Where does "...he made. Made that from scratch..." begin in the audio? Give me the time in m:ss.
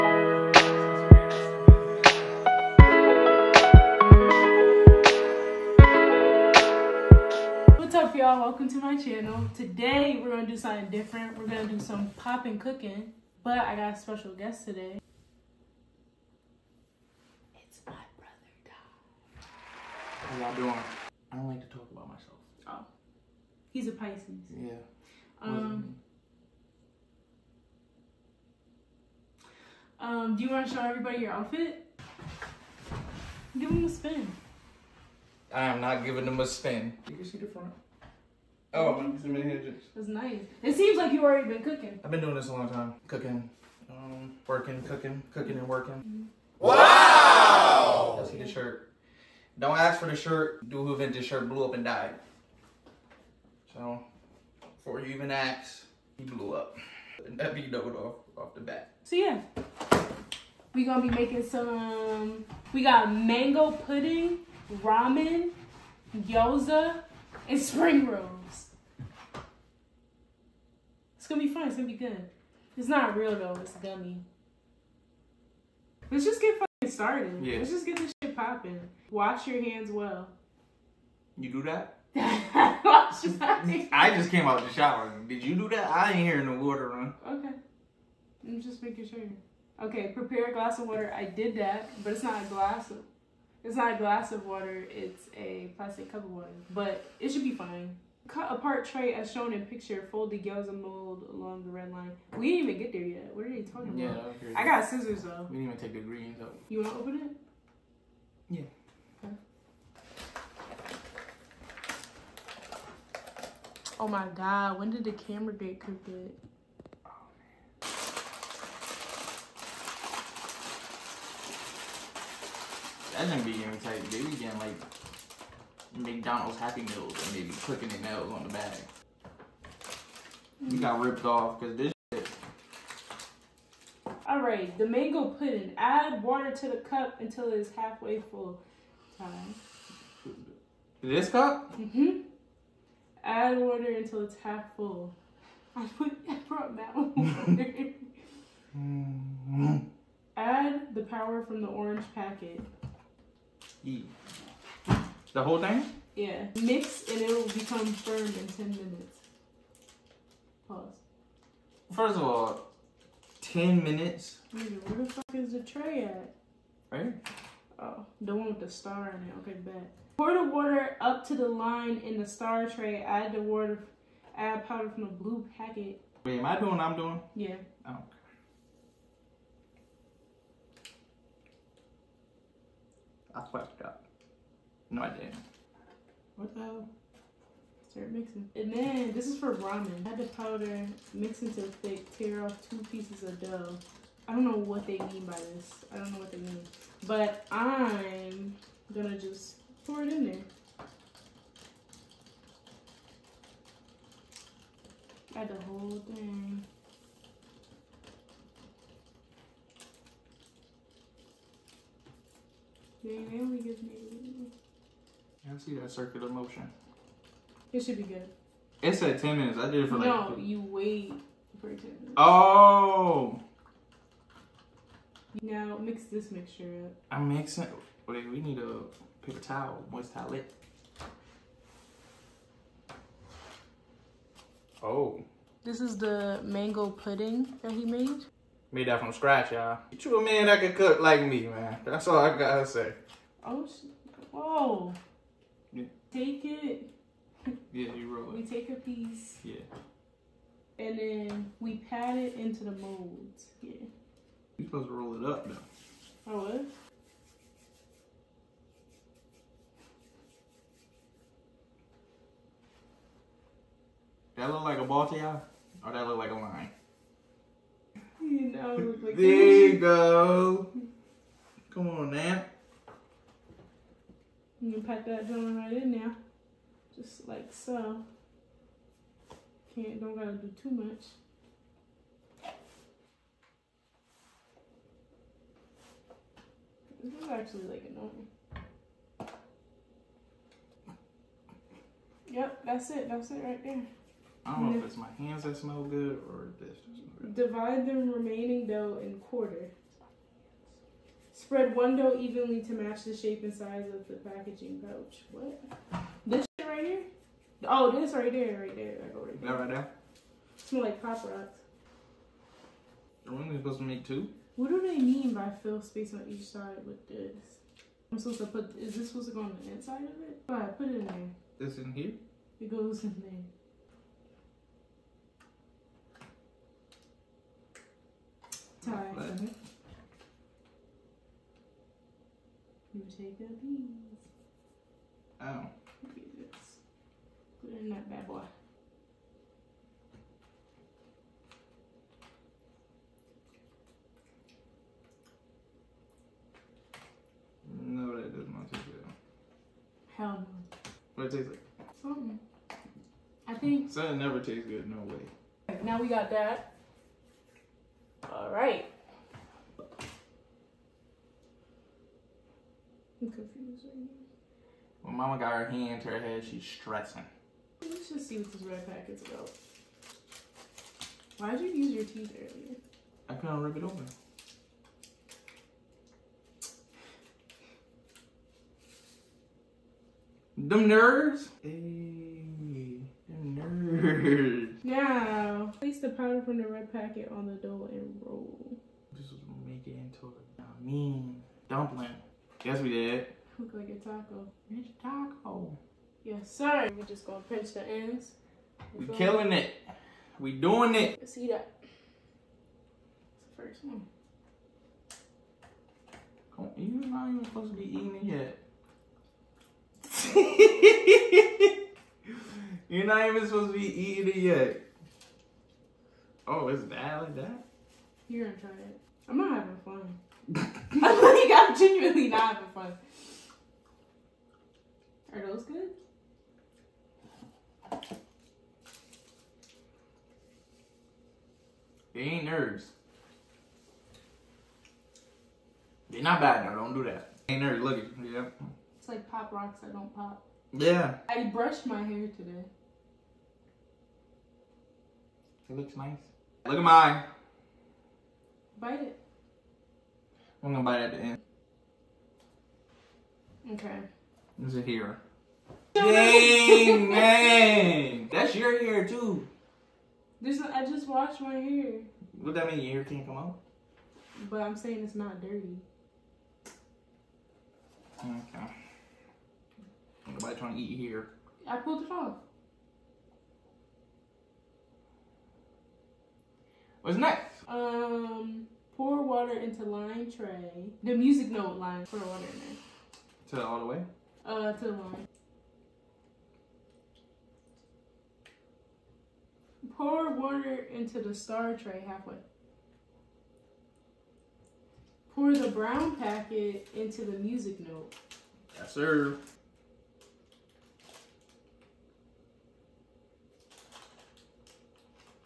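3:57.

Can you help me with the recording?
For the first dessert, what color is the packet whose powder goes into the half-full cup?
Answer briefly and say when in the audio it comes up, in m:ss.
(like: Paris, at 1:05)
Orange, at 2:31.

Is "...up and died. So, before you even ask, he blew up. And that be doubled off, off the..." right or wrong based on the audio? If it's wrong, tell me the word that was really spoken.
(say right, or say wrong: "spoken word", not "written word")
right.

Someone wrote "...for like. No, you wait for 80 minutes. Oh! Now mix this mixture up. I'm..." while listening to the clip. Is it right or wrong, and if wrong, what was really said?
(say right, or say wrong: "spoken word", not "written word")
wrong: "10", not "80".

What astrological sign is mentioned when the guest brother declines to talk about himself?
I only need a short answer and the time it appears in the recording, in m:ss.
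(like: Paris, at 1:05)
Pisces, at 0:23.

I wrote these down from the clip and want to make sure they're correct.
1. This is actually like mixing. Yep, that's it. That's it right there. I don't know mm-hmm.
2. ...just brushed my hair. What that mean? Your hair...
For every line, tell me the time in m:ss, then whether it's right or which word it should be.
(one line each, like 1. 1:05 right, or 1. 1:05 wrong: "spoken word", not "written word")
1. 4:47 wrong: "annoying", not "mixing"
2. 7:40 wrong: "washed", not "brushed".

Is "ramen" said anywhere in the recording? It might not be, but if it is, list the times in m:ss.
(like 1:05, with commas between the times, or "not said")
1:04, 3:09.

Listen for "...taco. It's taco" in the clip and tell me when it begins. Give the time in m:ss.
6:34.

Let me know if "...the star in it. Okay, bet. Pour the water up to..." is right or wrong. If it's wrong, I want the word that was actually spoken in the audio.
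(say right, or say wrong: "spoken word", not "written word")
right.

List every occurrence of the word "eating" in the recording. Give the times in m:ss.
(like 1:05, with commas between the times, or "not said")
6:47, 6:53.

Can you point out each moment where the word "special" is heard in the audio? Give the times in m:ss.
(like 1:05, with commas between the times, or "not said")
0:13.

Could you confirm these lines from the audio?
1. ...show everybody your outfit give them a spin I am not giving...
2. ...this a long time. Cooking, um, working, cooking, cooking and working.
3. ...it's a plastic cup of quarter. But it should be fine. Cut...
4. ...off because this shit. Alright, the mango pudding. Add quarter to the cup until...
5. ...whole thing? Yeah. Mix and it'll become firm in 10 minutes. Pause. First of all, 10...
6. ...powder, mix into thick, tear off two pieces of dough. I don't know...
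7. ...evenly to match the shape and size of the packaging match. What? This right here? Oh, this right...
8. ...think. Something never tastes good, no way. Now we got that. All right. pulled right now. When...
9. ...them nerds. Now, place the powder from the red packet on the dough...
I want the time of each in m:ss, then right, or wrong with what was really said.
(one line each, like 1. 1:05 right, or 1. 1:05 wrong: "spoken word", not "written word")
1. 0:30 right
2. 0:42 right
3. 1:34 wrong: "water", not "quarter"
4. 2:11 wrong: "water", not "quarter"
5. 2:35 right
6. 3:10 right
7. 5:02 wrong: "pouch", not "match"
8. 5:53 wrong: "confused", not "pulled"
9. 6:23 right.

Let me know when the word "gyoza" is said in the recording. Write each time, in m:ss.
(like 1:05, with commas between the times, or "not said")
1:06, 1:40.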